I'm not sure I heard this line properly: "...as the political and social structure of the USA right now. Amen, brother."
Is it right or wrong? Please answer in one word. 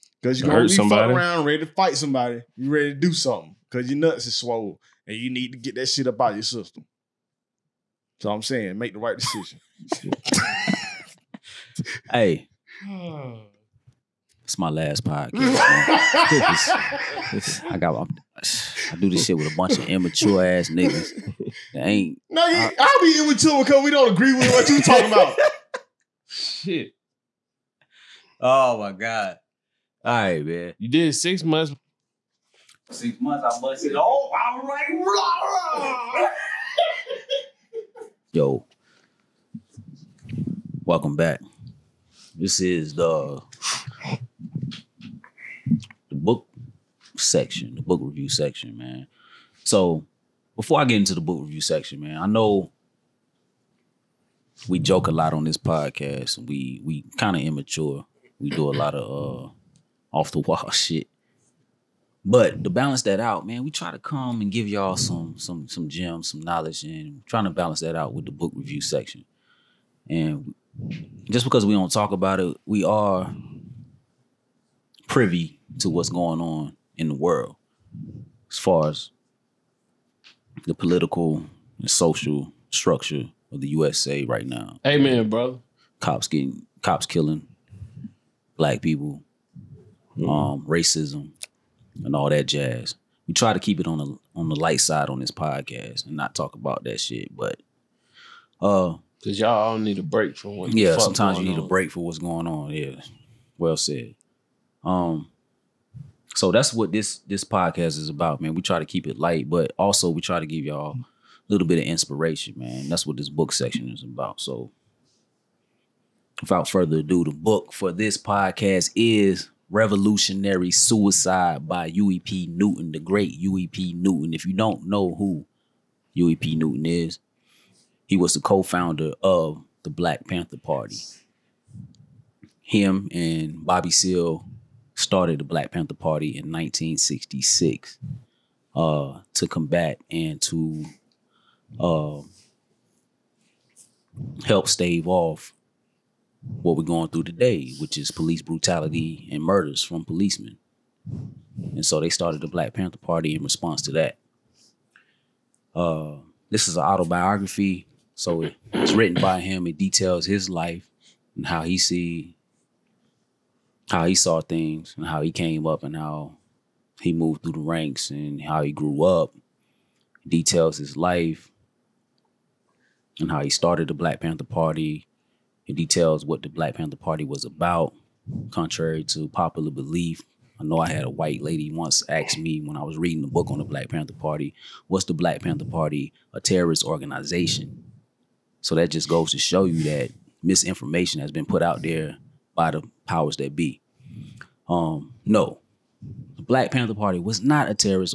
right.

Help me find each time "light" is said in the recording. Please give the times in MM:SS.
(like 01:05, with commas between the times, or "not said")
01:34, 01:49.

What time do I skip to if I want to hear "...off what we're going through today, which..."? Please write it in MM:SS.
02:25.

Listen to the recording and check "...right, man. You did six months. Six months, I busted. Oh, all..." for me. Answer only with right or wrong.
right.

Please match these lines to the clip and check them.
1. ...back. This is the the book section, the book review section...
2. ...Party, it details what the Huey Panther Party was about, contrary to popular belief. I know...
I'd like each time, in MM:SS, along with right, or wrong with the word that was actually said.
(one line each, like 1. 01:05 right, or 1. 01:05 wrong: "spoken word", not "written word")
1. 00:41 right
2. 02:54 wrong: "Black", not "Huey".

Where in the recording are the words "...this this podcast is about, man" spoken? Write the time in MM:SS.
01:46.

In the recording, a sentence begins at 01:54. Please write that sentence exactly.
So, without further ado, the book for this podcast is Revolutionary Suicide by Huey P.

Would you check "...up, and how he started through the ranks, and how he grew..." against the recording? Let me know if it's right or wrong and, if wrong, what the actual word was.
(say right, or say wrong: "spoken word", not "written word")
wrong: "moved", not "started".